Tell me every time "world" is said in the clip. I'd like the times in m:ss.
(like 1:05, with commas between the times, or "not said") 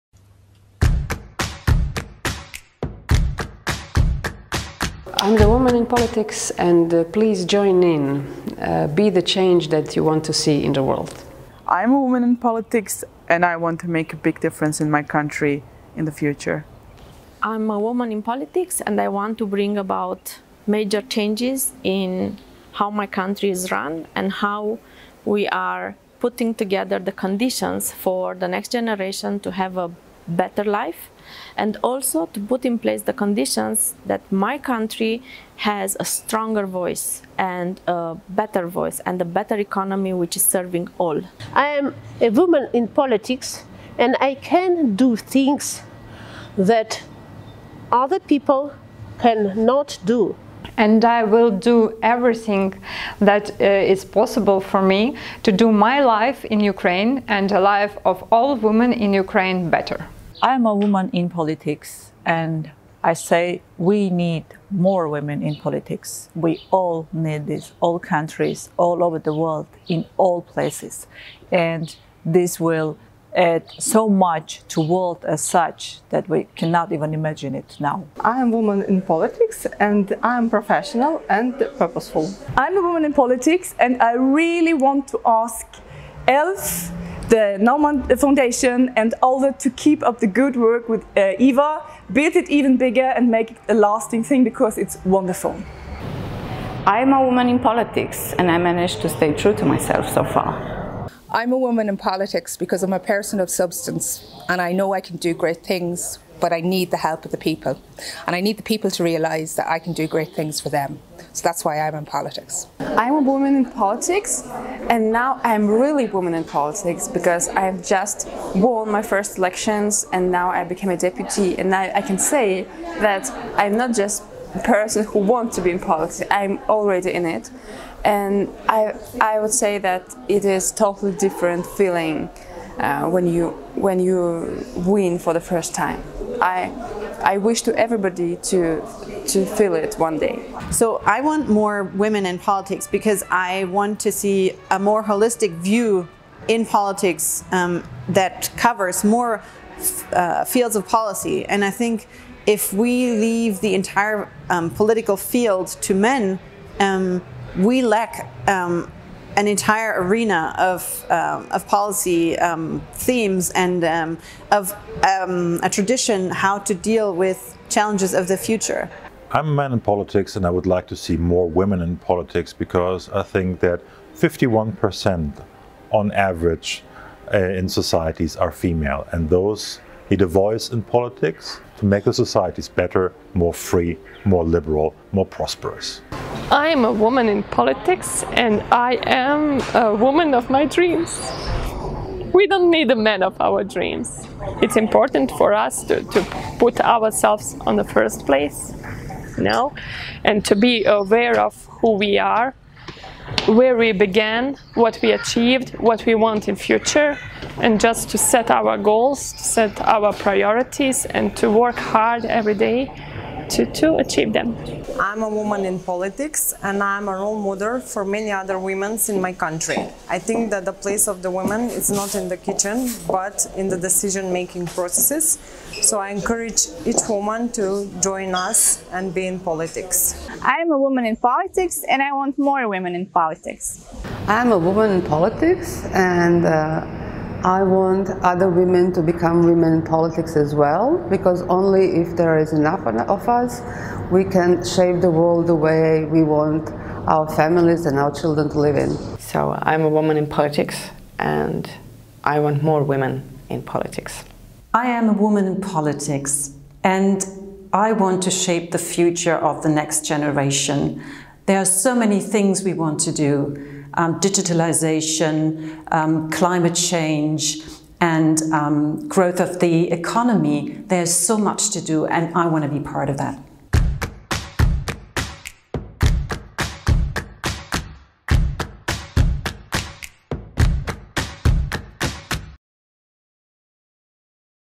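0:10, 1:09, 1:14, 4:05.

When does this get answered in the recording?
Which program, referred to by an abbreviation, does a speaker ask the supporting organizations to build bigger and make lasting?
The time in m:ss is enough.
1:31.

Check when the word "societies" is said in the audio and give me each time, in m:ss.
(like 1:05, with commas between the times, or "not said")
2:57, 3:02.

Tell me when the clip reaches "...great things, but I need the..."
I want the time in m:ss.
1:45.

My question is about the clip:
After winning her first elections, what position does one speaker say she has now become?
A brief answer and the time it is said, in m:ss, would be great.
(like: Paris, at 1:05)
Deputy, at 2:00.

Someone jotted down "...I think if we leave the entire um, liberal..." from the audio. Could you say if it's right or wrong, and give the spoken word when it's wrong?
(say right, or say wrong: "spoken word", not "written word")
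wrong: "political", not "liberal".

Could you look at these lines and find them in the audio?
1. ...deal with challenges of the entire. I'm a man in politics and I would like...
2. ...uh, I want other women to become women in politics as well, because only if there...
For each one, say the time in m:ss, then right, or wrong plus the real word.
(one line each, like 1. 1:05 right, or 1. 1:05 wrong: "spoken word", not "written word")
1. 2:46 wrong: "future", not "entire"
2. 3:56 right.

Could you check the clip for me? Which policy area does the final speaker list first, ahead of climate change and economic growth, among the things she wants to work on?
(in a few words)
Digitalization.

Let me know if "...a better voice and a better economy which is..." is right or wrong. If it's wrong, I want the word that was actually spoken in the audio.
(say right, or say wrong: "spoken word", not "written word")
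right.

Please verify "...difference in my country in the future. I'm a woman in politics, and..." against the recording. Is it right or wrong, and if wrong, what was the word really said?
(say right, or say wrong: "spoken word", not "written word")
right.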